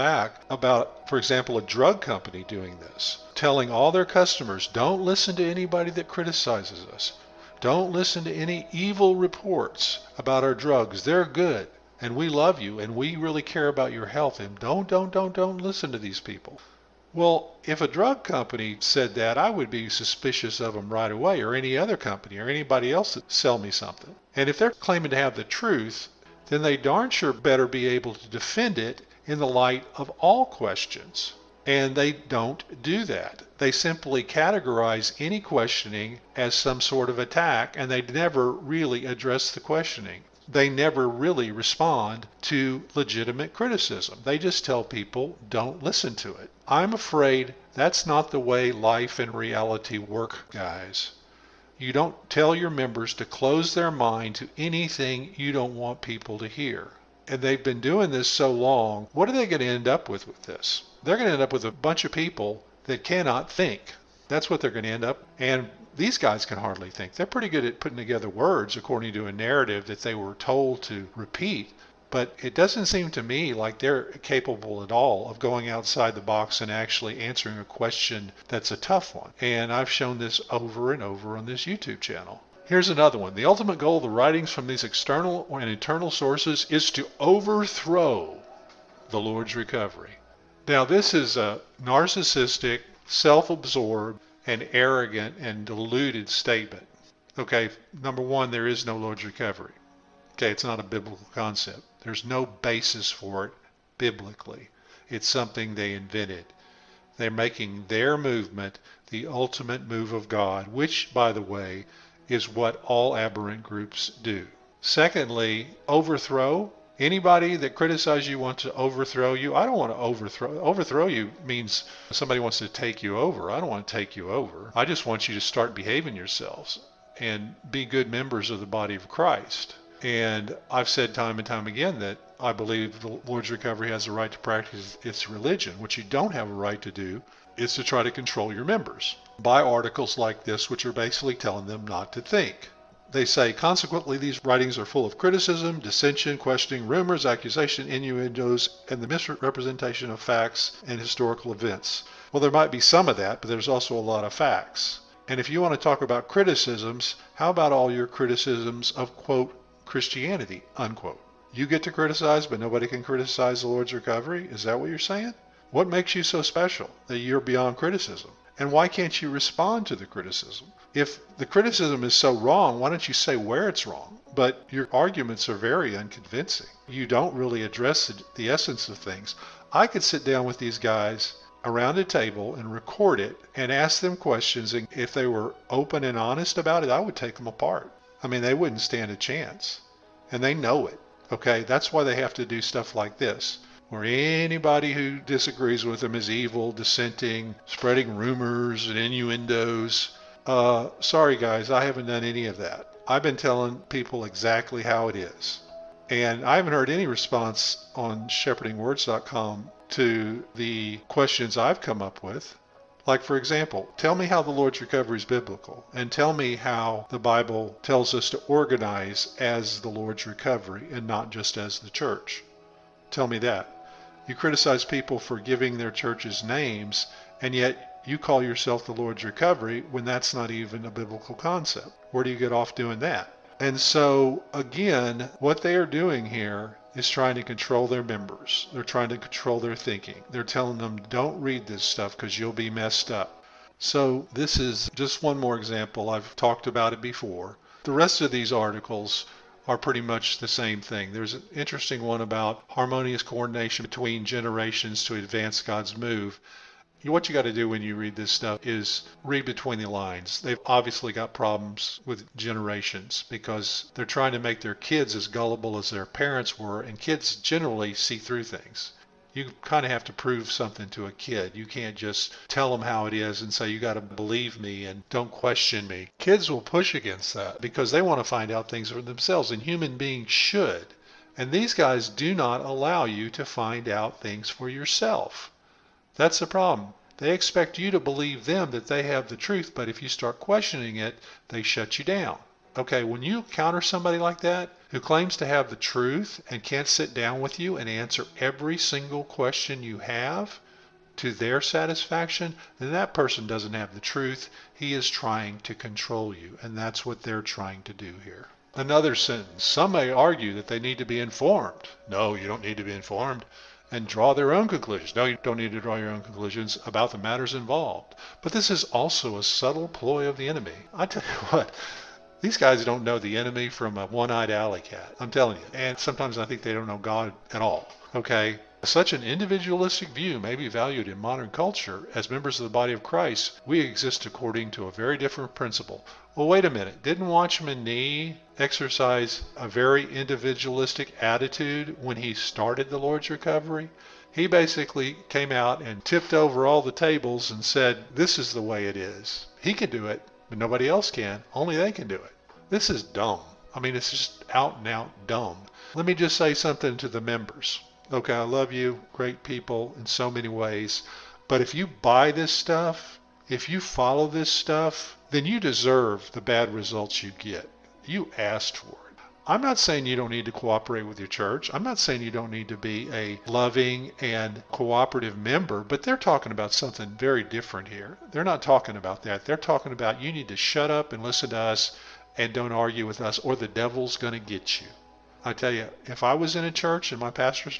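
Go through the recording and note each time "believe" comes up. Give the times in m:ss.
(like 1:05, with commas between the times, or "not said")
2:12, 4:34, 4:48.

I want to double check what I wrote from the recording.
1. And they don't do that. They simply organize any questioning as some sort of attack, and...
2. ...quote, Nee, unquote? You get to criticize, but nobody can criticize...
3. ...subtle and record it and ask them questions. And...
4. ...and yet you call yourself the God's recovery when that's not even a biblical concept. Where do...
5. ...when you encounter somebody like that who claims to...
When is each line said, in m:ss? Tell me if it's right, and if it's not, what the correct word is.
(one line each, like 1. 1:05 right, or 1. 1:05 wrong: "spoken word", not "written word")
1. 0:31 wrong: "categorize", not "organize"
2. 2:39 wrong: "Christianity", not "Nee"
3. 3:02 wrong: "table", not "subtle"
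4. 3:47 wrong: "Lord", not "God"
5. 4:53 right.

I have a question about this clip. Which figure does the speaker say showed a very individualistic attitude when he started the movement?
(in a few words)
Watchman Nee.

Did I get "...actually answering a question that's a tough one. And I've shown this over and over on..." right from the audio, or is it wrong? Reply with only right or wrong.
right.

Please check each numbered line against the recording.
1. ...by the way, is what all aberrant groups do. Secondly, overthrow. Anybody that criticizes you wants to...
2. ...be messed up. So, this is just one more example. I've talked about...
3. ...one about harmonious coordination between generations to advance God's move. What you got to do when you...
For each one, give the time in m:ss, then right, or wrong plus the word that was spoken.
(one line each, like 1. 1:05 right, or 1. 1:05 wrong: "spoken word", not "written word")
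1. 1:51 right
2. 4:02 right
3. 4:12 right.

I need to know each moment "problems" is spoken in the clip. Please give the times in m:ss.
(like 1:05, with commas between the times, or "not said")
4:21, 4:46.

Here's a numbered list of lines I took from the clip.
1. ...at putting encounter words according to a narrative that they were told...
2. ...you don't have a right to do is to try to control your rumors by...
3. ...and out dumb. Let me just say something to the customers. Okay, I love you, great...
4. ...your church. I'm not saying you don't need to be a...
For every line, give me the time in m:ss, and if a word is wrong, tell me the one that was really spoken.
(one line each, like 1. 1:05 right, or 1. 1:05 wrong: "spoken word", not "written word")
1. 1:07 wrong: "together", not "encounter"
2. 2:15 wrong: "members", not "rumors"
3. 5:54 wrong: "members", not "customers"
4. 6:11 right.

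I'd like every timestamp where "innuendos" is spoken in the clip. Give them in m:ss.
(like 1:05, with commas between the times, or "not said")
2:27, 3:18.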